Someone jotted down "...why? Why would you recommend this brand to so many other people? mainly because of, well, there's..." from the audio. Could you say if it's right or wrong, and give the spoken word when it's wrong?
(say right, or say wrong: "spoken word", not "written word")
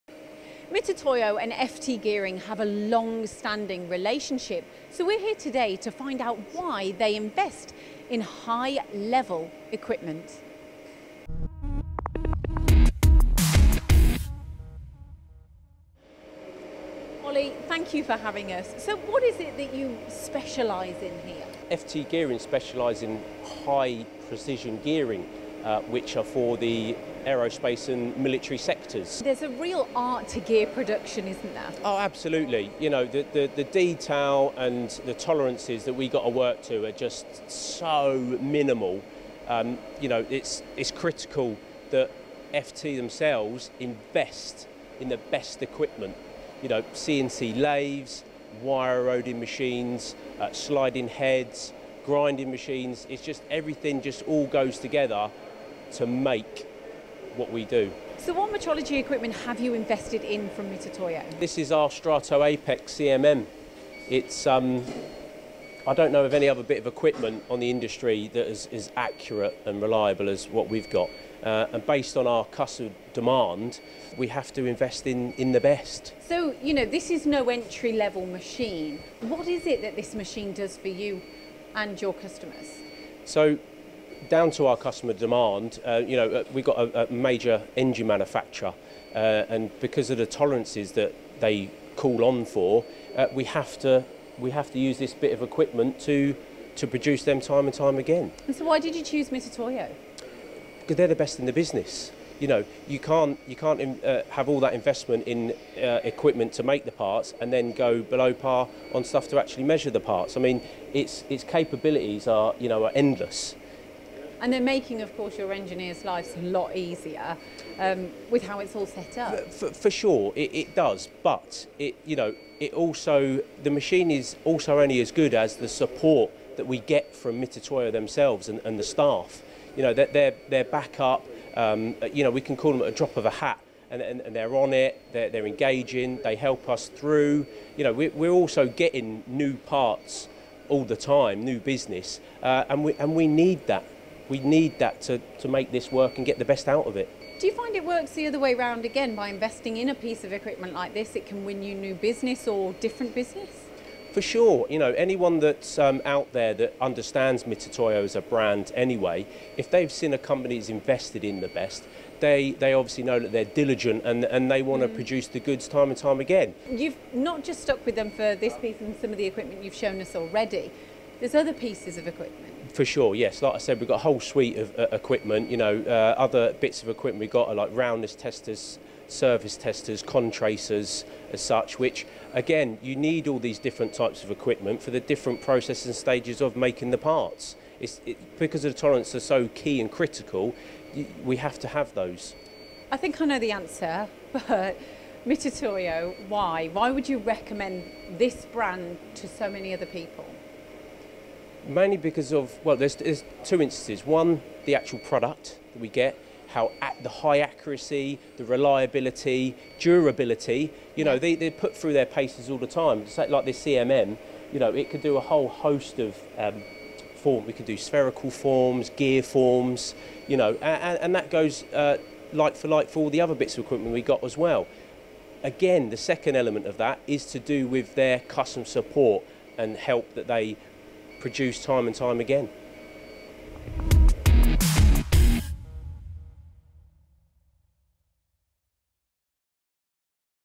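right.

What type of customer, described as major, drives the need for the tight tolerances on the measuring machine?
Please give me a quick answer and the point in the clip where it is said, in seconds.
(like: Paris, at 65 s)
engine manufacturer, at 87 s.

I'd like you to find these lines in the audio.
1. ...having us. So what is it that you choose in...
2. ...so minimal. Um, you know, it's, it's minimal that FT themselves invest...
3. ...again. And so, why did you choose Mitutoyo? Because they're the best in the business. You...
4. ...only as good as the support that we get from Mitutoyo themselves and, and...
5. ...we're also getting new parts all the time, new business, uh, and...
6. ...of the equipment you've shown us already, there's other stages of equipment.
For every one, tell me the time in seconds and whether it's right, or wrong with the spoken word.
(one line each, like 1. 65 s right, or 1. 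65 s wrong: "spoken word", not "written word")
1. 18 s wrong: "specialise", not "choose"
2. 37 s wrong: "critical", not "minimal"
3. 97 s right
4. 124 s right
5. 138 s right
6. 169 s wrong: "pieces", not "stages".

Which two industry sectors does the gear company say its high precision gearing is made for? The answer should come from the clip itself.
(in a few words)
aerospace and military.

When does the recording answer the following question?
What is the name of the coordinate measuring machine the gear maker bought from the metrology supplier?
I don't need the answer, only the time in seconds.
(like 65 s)
61 s.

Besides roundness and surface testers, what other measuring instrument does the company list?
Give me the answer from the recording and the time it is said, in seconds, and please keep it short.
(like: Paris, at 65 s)
Contracers, at 180 s.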